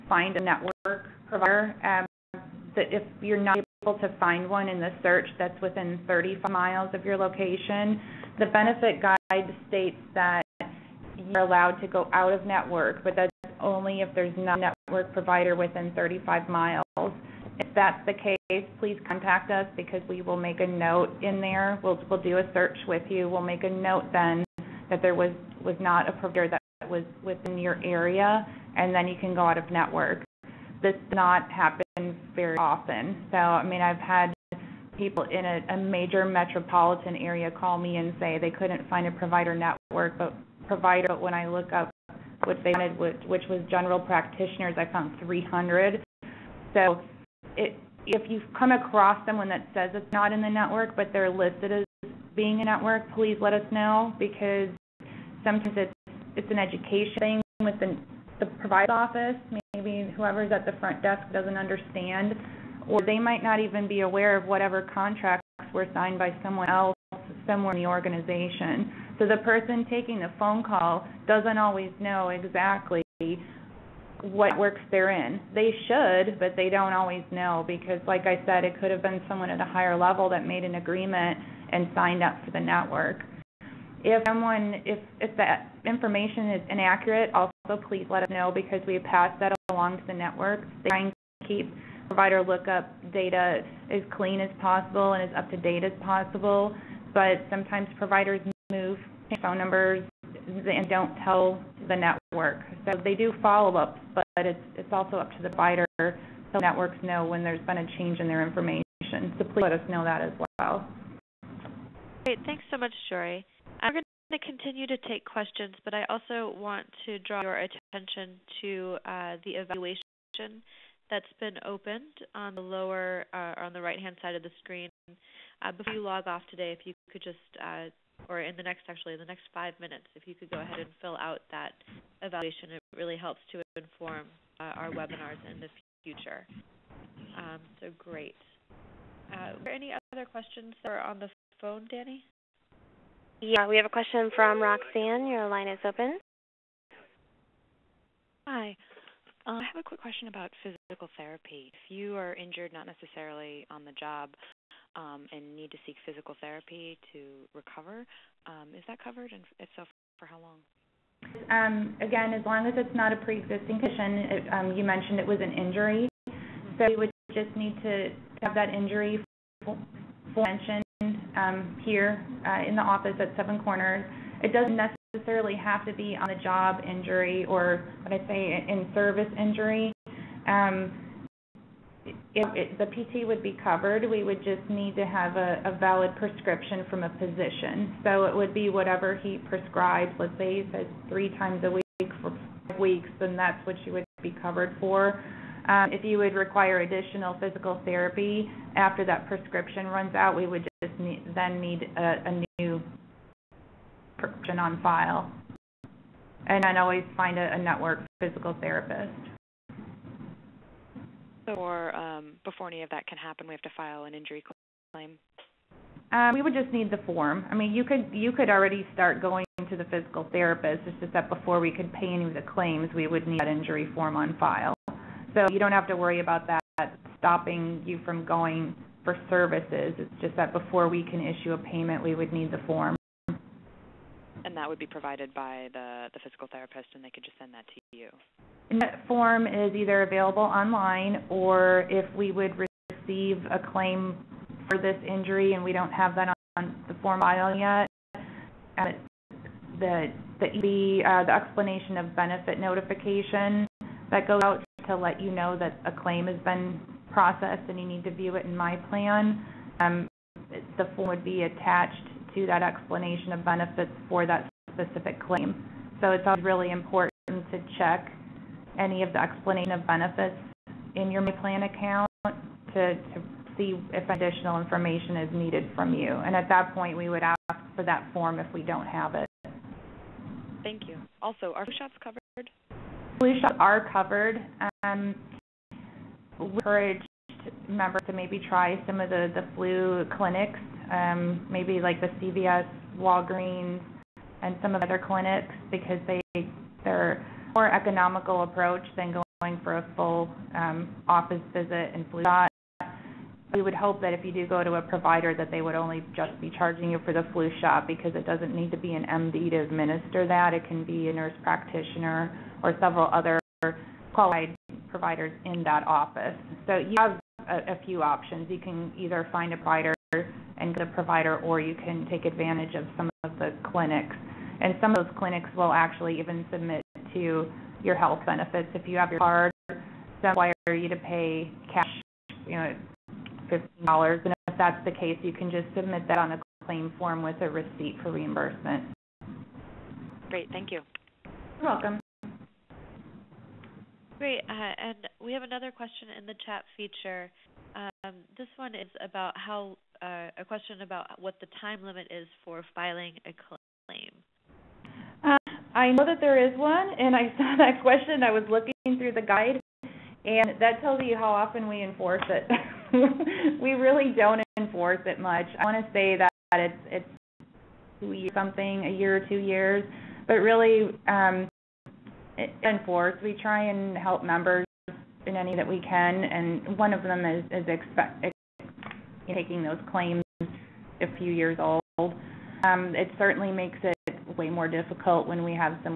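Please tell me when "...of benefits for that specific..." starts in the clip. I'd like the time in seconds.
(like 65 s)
263 s.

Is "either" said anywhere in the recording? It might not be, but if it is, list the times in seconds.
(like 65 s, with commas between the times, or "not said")
239 s, 318 s.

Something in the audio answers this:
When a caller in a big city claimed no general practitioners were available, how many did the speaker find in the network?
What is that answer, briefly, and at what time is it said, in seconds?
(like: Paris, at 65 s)
300, at 45 s.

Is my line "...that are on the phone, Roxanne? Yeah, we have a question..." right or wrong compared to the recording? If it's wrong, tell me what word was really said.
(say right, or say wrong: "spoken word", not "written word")
wrong: "Danny", not "Roxanne".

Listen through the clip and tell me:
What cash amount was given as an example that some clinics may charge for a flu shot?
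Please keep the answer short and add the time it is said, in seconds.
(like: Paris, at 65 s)
$15, at 333 s.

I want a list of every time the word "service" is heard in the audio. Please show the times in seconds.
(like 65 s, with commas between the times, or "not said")
178 s, 229 s.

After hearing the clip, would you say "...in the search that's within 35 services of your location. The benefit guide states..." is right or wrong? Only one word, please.
wrong.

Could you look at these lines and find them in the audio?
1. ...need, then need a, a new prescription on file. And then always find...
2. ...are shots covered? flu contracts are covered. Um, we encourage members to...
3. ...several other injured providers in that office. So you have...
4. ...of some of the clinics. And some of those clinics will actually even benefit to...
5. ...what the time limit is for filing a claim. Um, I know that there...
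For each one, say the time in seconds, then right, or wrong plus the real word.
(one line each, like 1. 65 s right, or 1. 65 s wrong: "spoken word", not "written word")
1. 200 s right
2. 281 s wrong: "shots", not "contracts"
3. 312 s wrong: "qualified", not "injured"
4. 322 s wrong: "submit", not "benefit"
5. 351 s right.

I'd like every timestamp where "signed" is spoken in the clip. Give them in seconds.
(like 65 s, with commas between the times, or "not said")
65 s, 81 s.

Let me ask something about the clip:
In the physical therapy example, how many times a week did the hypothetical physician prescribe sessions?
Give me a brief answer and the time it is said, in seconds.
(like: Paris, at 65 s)
3, at 191 s.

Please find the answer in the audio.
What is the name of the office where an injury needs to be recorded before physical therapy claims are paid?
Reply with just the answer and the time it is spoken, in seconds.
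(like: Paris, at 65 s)
Seven Corners, at 173 s.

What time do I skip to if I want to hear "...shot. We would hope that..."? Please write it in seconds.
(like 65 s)
302 s.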